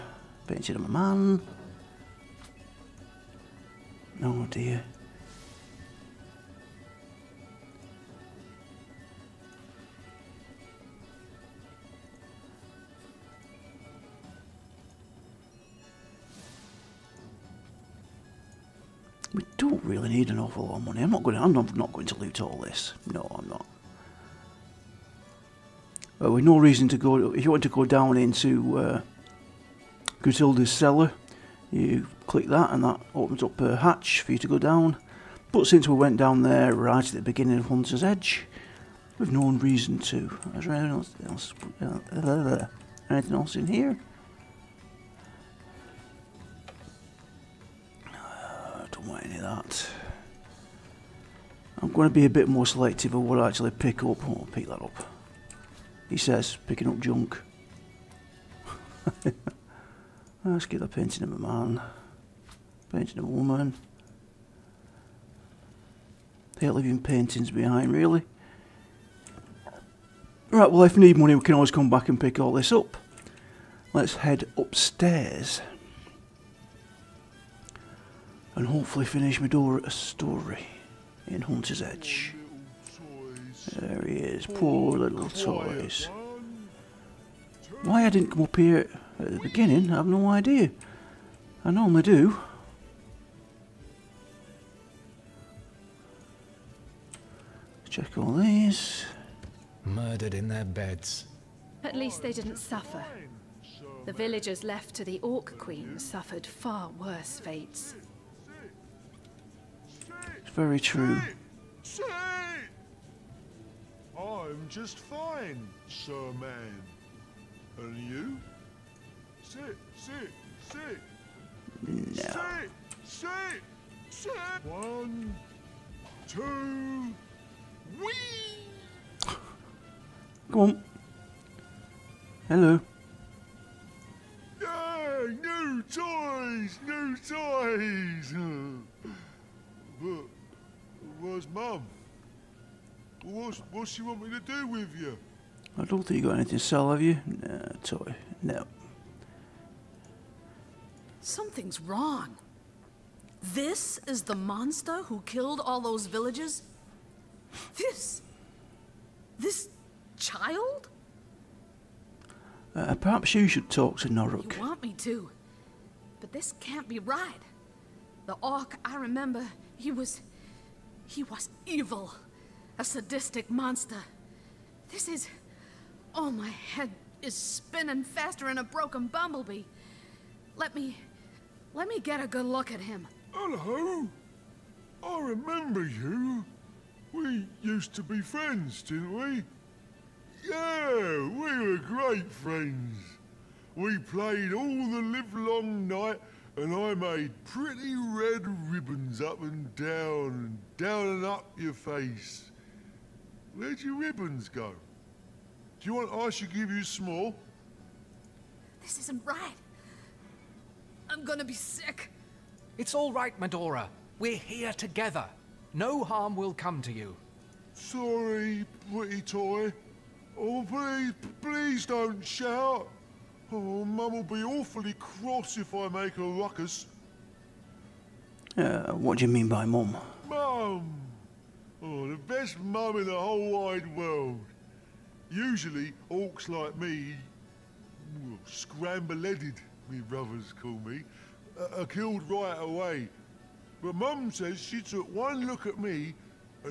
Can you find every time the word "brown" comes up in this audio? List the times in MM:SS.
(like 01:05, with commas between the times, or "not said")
not said.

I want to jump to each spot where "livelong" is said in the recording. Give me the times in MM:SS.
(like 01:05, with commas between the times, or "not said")
03:15.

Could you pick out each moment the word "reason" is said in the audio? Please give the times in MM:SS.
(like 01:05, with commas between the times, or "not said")
00:26, 00:39.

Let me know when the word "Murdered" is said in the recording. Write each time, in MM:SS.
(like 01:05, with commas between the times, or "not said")
01:39.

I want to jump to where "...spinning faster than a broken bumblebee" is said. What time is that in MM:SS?
02:57.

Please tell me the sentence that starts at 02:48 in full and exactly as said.
The Orc I remember, he was...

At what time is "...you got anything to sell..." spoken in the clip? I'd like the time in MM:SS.
02:26.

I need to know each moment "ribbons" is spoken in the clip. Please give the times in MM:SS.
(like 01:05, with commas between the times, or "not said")
03:18, 03:24.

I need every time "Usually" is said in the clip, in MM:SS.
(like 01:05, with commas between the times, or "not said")
03:55.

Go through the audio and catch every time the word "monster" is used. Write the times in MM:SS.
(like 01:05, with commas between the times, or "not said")
02:34, 02:53.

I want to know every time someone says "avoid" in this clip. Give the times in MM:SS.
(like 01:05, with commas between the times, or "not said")
not said.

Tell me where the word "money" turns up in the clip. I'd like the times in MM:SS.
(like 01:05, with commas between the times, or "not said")
00:20, 01:11.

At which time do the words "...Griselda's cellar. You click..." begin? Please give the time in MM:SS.
00:30.